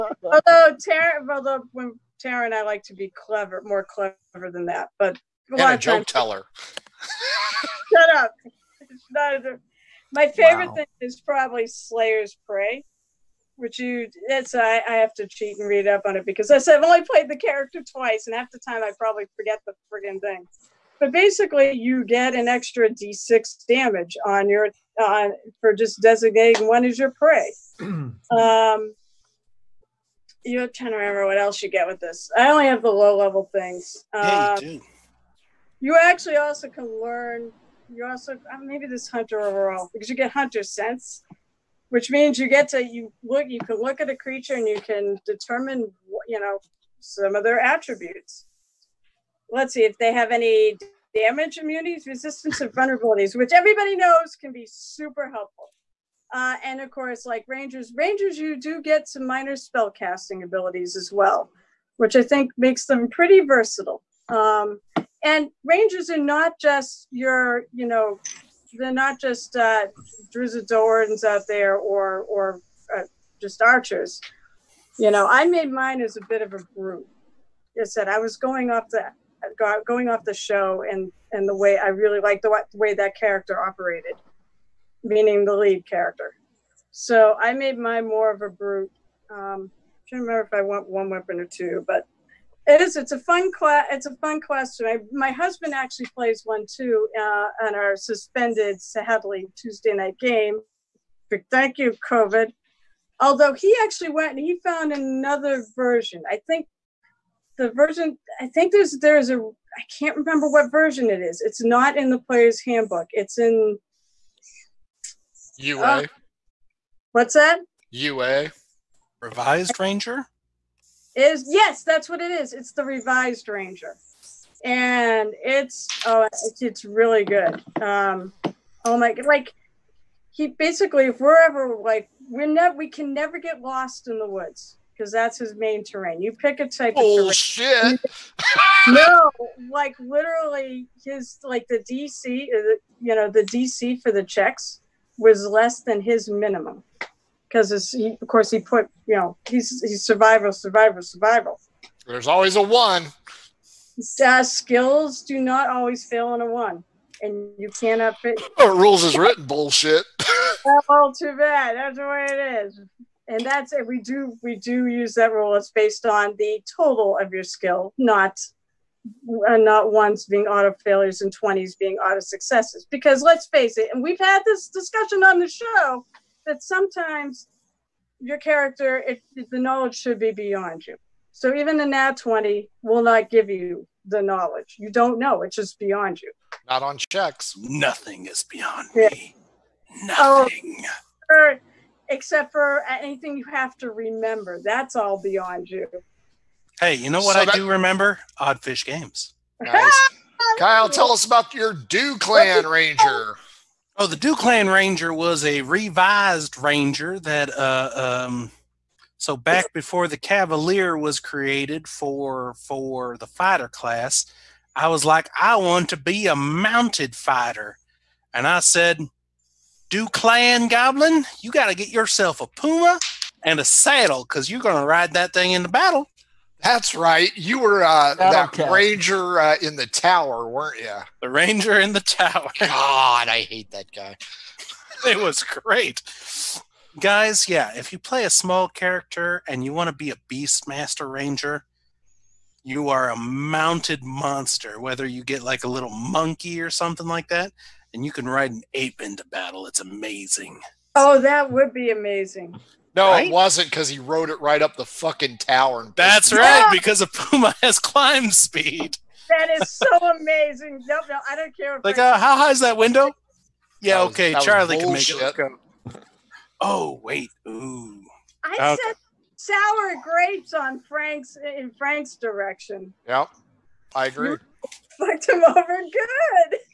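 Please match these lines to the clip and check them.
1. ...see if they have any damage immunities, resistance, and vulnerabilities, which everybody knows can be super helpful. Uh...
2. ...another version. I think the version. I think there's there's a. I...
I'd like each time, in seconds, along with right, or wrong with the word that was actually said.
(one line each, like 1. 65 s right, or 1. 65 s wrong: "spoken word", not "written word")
1. 49 s right
2. 104 s right.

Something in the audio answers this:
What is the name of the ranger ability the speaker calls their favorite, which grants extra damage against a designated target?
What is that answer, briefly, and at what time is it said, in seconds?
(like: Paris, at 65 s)
Slayer's Prey, at 11 s.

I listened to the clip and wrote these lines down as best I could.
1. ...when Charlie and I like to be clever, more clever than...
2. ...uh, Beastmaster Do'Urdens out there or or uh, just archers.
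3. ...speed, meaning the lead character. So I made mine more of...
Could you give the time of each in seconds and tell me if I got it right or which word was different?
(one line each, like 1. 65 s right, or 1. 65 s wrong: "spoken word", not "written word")
1. 1 s wrong: "Tara", not "Charlie"
2. 69 s wrong: "Drizzt", not "Beastmaster"
3. 83 s wrong: "operated", not "speed".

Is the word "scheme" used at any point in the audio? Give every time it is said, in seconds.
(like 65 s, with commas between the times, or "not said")
not said.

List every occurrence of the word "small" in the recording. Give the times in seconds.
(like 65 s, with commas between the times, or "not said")
238 s.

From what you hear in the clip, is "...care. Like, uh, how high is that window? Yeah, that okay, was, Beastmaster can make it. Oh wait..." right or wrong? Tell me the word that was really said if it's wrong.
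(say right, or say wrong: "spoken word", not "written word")
wrong: "Charlie", not "Beastmaster".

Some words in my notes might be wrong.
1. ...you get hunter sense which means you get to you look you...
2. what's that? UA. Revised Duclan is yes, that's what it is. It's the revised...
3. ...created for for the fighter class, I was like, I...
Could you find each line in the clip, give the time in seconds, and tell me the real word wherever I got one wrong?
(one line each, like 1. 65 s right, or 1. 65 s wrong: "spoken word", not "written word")
1. 40 s right
2. 117 s wrong: "Ranger", not "Duclan"
3. 211 s right.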